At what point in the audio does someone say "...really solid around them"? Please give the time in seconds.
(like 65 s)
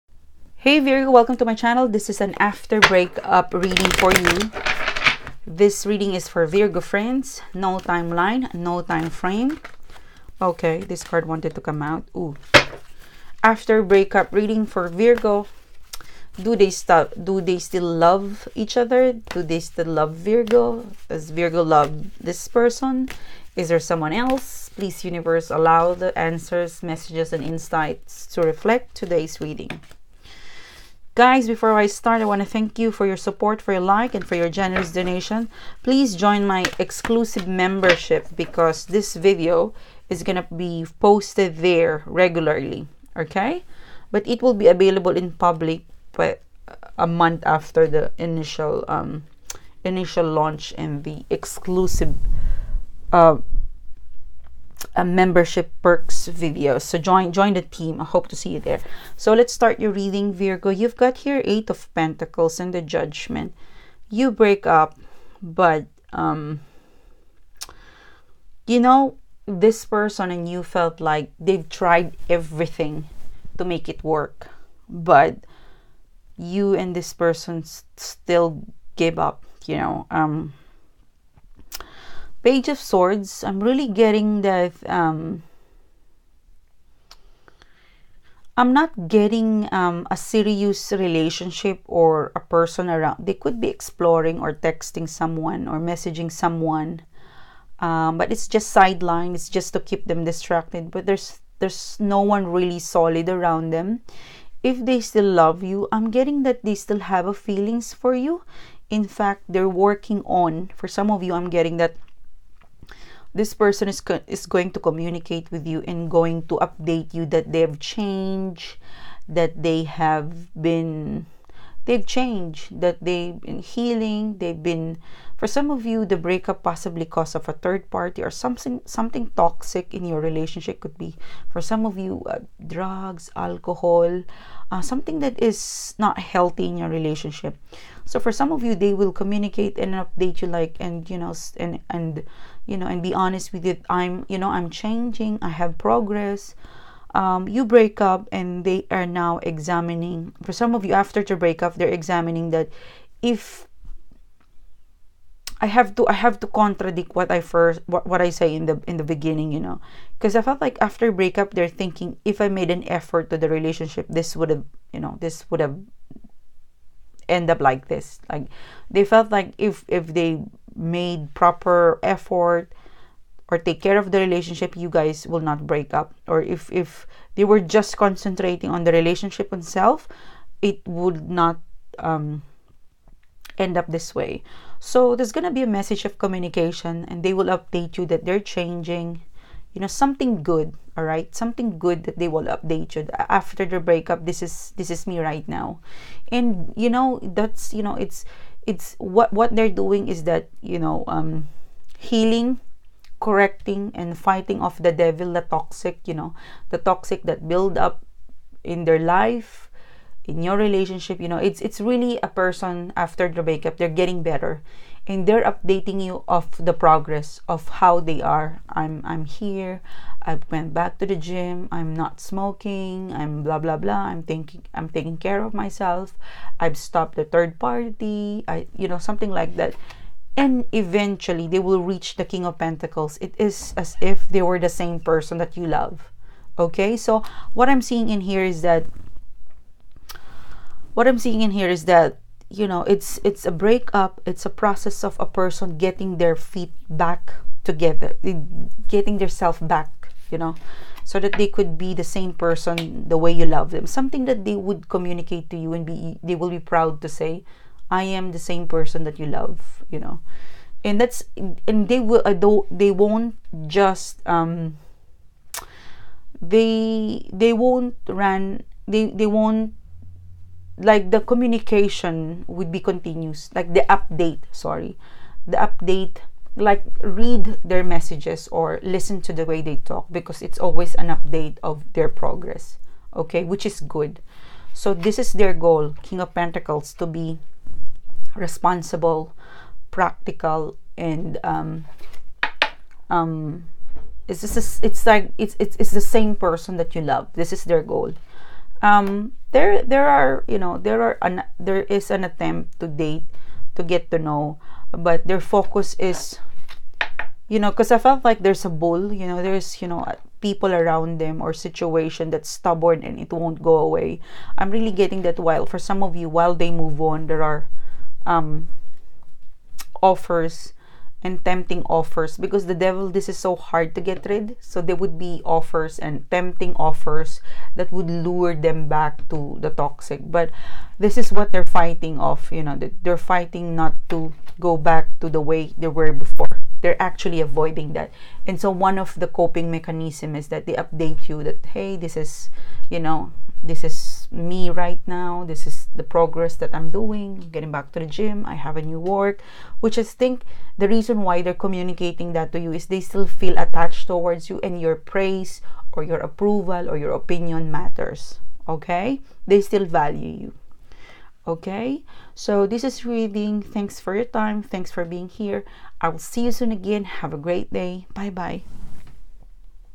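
102 s.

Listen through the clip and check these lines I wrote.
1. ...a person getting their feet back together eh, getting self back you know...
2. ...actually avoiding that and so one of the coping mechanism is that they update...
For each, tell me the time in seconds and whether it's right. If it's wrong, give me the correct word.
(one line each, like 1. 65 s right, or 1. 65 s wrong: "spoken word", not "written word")
1. 245 s right
2. 336 s right.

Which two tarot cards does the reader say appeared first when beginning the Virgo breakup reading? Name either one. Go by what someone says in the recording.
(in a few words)
Eight of Pentacles.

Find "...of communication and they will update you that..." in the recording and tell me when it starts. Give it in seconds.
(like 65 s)
186 s.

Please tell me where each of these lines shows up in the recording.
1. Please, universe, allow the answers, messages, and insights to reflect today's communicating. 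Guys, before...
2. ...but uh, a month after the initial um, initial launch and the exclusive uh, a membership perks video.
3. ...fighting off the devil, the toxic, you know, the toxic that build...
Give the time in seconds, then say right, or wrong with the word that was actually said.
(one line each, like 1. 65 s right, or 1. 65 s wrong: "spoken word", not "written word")
1. 24 s wrong: "reading", not "communicating"
2. 46 s right
3. 204 s right.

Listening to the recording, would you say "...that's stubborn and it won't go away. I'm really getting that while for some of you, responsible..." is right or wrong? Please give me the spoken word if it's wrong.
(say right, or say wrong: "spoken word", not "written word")
wrong: "while", not "responsible".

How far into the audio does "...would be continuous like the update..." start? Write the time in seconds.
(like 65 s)
272 s.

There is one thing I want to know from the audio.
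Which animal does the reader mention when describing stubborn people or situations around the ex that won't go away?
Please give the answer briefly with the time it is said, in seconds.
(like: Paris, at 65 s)
bull, at 308 s.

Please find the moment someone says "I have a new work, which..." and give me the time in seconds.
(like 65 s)
348 s.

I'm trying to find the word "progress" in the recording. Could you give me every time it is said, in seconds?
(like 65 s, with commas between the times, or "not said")
145 s, 216 s, 282 s, 346 s.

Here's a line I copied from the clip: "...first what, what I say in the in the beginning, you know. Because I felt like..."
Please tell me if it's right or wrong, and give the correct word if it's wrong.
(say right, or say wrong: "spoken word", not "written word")
right.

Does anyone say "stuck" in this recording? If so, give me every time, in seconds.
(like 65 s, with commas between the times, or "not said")
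not said.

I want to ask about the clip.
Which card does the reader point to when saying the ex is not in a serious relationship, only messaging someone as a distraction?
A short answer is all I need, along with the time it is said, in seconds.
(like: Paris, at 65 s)
Page of Swords, at 82 s.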